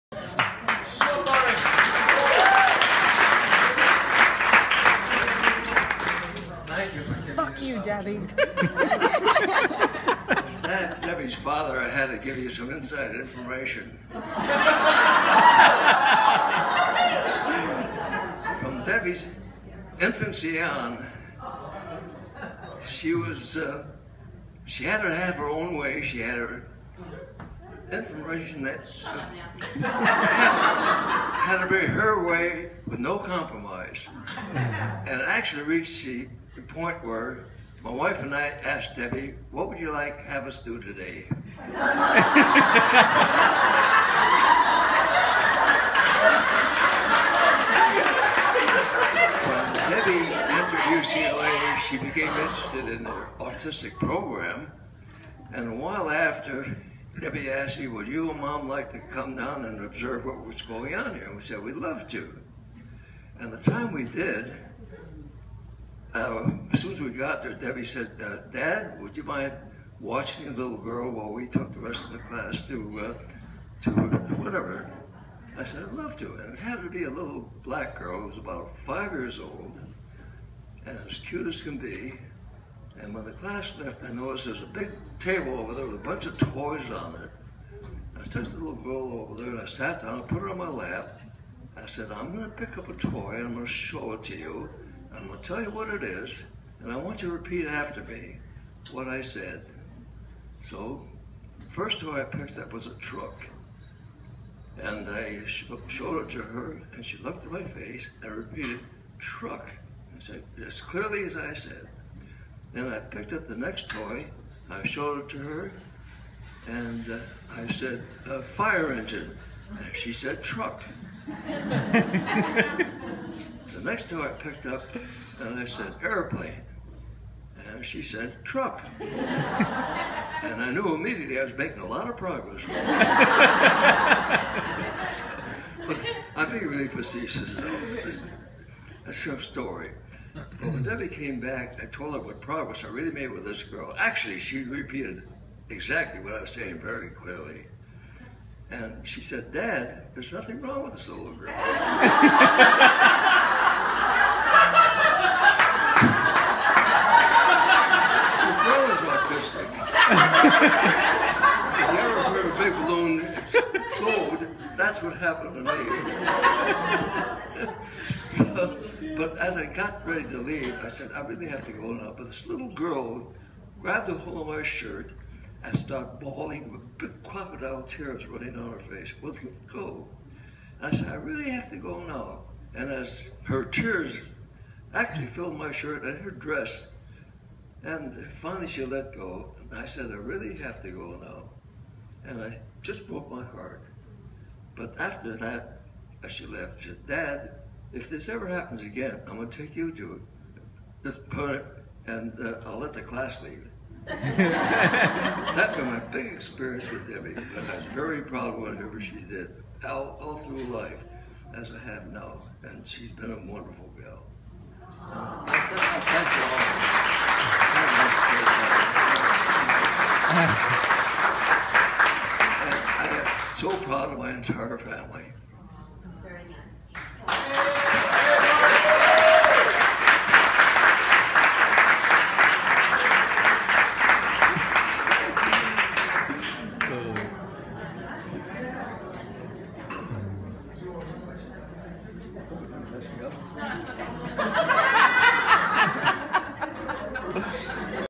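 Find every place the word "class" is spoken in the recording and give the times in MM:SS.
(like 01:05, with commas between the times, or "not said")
01:12, 01:23, 03:23.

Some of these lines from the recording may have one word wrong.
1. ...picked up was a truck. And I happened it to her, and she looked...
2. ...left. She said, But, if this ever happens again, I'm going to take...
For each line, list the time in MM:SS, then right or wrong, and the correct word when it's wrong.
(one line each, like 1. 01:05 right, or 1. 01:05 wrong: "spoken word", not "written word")
1. 01:42 wrong: "showed", not "happened"
2. 03:16 wrong: "Dad", not "But".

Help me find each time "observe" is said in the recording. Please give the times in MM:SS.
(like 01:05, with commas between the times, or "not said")
00:59.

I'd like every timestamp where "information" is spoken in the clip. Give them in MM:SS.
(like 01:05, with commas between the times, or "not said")
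00:13, 00:27.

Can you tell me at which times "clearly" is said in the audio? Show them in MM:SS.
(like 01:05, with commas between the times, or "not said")
01:50, 02:27.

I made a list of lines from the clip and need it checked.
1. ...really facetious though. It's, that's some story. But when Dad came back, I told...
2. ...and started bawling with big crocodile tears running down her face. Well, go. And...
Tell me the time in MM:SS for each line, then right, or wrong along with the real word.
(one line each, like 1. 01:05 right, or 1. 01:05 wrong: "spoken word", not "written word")
1. 02:16 wrong: "Debbie", not "Dad"
2. 02:55 right.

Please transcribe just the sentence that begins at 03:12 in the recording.
And I just broke my heart.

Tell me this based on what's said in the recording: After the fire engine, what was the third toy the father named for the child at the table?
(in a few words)
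airplane.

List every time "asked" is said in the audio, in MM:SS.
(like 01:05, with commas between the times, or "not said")
00:38, 00:57.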